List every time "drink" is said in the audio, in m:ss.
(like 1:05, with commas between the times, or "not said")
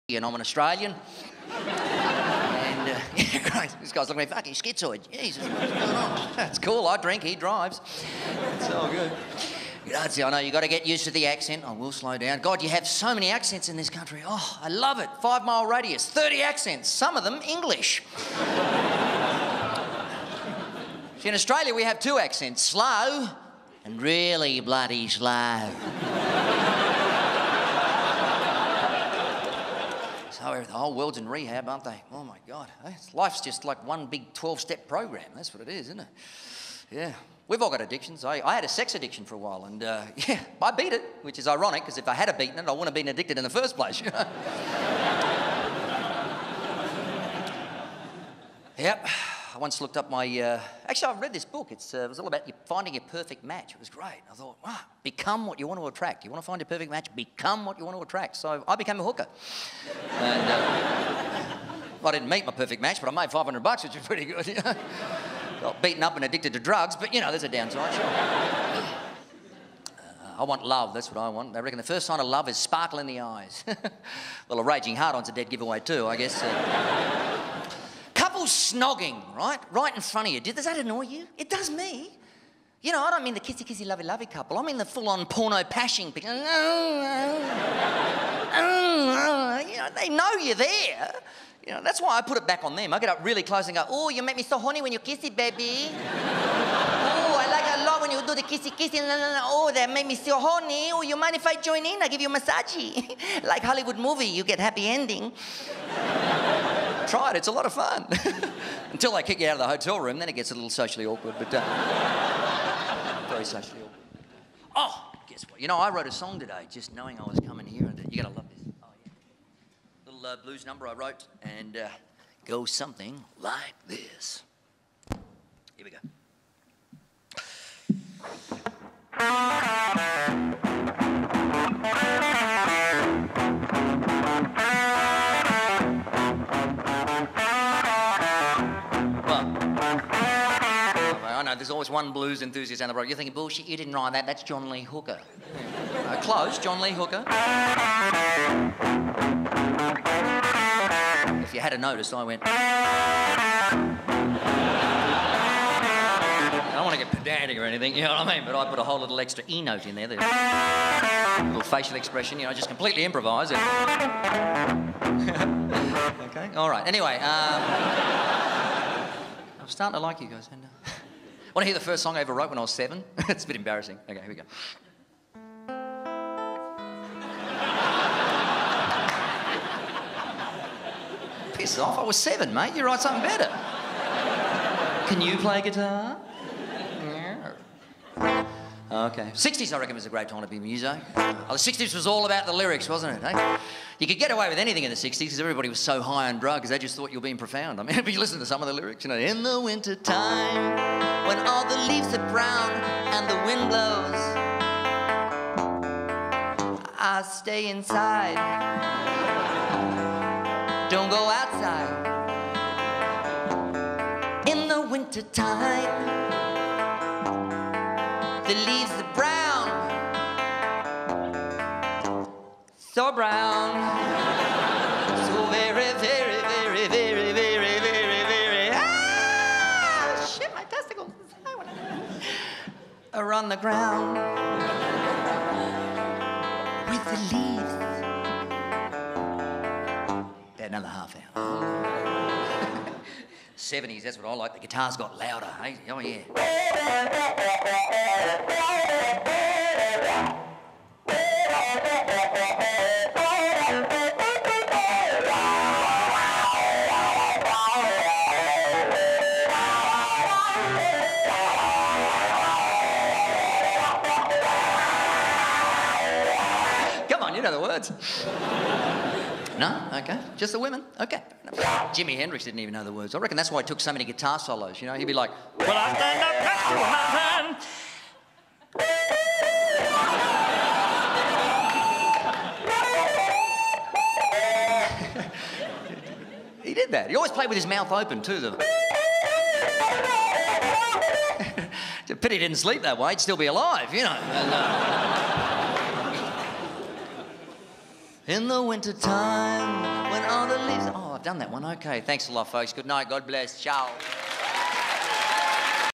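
0:06.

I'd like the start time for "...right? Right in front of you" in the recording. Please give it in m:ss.
1:19.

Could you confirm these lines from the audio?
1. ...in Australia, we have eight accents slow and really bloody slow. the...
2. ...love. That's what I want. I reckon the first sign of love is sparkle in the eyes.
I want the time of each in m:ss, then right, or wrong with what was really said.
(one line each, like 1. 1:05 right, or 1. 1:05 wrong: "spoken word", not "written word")
1. 0:21 wrong: "two", not "eight"
2. 1:10 right.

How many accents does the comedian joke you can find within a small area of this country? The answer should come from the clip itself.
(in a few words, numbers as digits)
30.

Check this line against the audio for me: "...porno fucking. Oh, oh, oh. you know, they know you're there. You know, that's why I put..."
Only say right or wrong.
wrong.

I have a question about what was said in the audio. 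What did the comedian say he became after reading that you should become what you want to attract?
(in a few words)
a hooker.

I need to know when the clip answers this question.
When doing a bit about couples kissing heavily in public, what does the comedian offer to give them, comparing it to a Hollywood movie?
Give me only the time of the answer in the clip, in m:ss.
1:42.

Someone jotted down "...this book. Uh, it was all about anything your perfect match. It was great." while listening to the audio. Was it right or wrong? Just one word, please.
wrong.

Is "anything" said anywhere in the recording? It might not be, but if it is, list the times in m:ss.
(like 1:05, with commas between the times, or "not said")
2:37, 3:14.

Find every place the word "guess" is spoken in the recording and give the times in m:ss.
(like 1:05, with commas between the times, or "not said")
1:16, 1:55.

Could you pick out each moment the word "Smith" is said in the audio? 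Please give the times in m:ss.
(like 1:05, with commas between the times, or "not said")
not said.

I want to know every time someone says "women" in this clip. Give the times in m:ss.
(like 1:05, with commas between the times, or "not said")
4:30.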